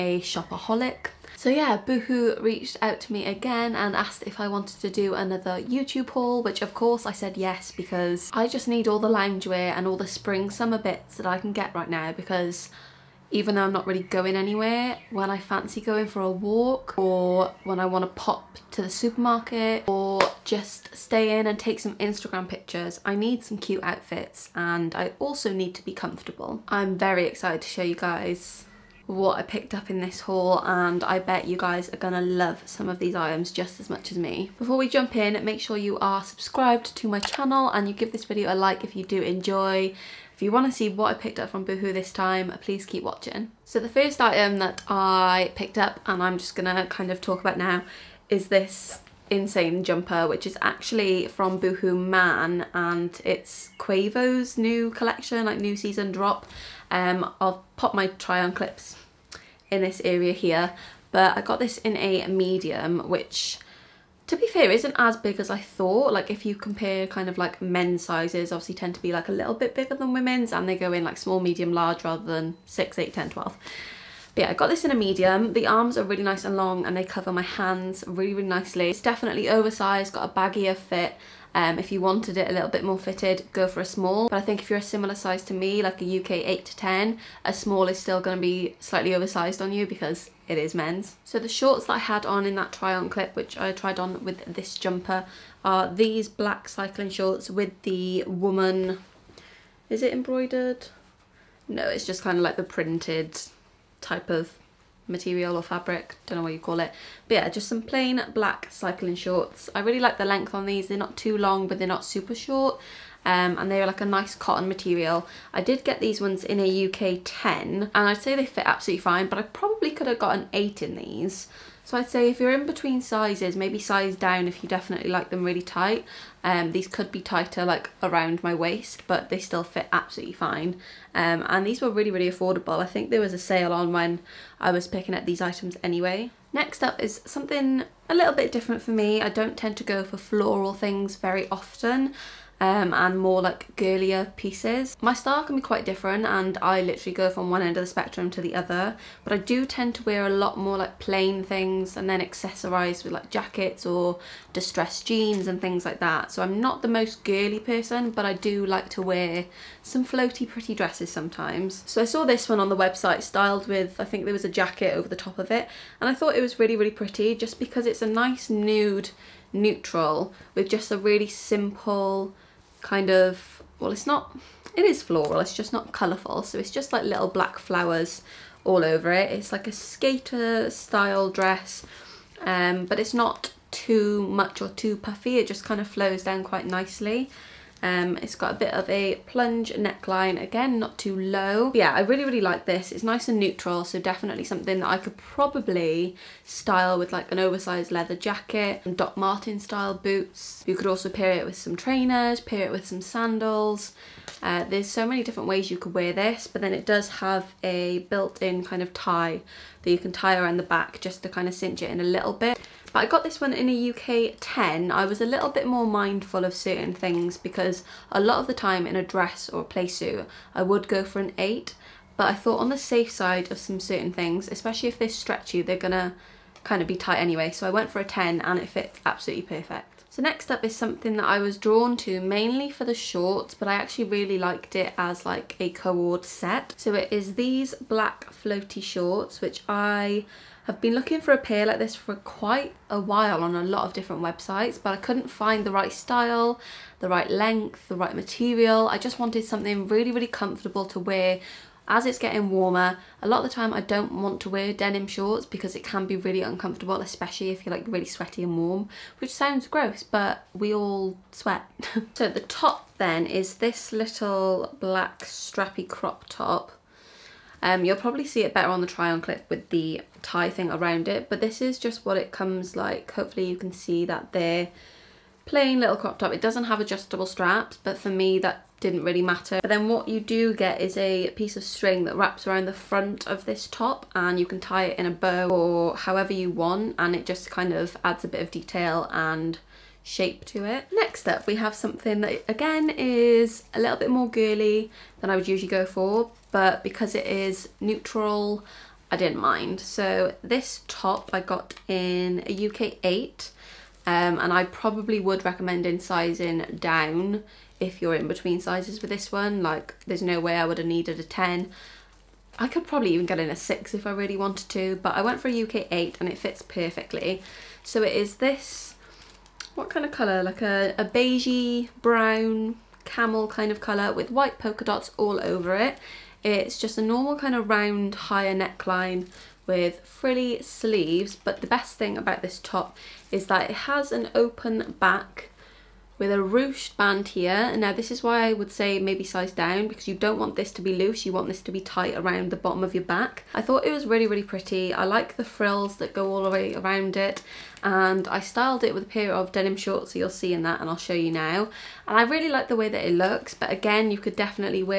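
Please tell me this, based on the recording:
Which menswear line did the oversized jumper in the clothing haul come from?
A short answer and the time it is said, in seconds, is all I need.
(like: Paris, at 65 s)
Boohoo Man, at 51 s.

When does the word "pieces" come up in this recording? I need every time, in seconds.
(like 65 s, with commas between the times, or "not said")
144 s, 281 s.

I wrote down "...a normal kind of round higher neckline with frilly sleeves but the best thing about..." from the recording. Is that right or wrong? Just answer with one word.
right.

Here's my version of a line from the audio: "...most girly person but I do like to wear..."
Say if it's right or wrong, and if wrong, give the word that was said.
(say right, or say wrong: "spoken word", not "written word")
right.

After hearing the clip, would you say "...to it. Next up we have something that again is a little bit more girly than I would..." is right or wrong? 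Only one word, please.
right.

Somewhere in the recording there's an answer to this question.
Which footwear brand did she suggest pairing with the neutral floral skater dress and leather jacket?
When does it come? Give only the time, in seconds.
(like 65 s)
198 s.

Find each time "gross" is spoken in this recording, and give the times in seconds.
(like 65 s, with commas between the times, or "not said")
259 s.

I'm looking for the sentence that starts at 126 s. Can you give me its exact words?
Um, these could be tighter like around my waist, but they still fit absolutely fine.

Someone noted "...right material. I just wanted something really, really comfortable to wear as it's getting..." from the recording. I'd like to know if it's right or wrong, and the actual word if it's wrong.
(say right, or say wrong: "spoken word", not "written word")
right.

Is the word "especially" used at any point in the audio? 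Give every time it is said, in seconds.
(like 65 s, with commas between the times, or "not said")
224 s, 257 s.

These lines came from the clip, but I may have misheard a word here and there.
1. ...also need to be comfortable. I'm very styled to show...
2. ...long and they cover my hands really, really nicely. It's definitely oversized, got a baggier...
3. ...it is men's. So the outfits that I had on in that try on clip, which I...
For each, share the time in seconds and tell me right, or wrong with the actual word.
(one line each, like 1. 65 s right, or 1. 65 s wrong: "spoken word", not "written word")
1. 25 s wrong: "excited", not "styled"
2. 76 s right
3. 90 s wrong: "shorts", not "outfits".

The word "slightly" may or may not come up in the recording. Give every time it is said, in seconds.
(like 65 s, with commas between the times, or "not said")
88 s.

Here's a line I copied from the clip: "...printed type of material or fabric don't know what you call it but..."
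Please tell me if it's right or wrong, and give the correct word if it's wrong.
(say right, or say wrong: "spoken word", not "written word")
right.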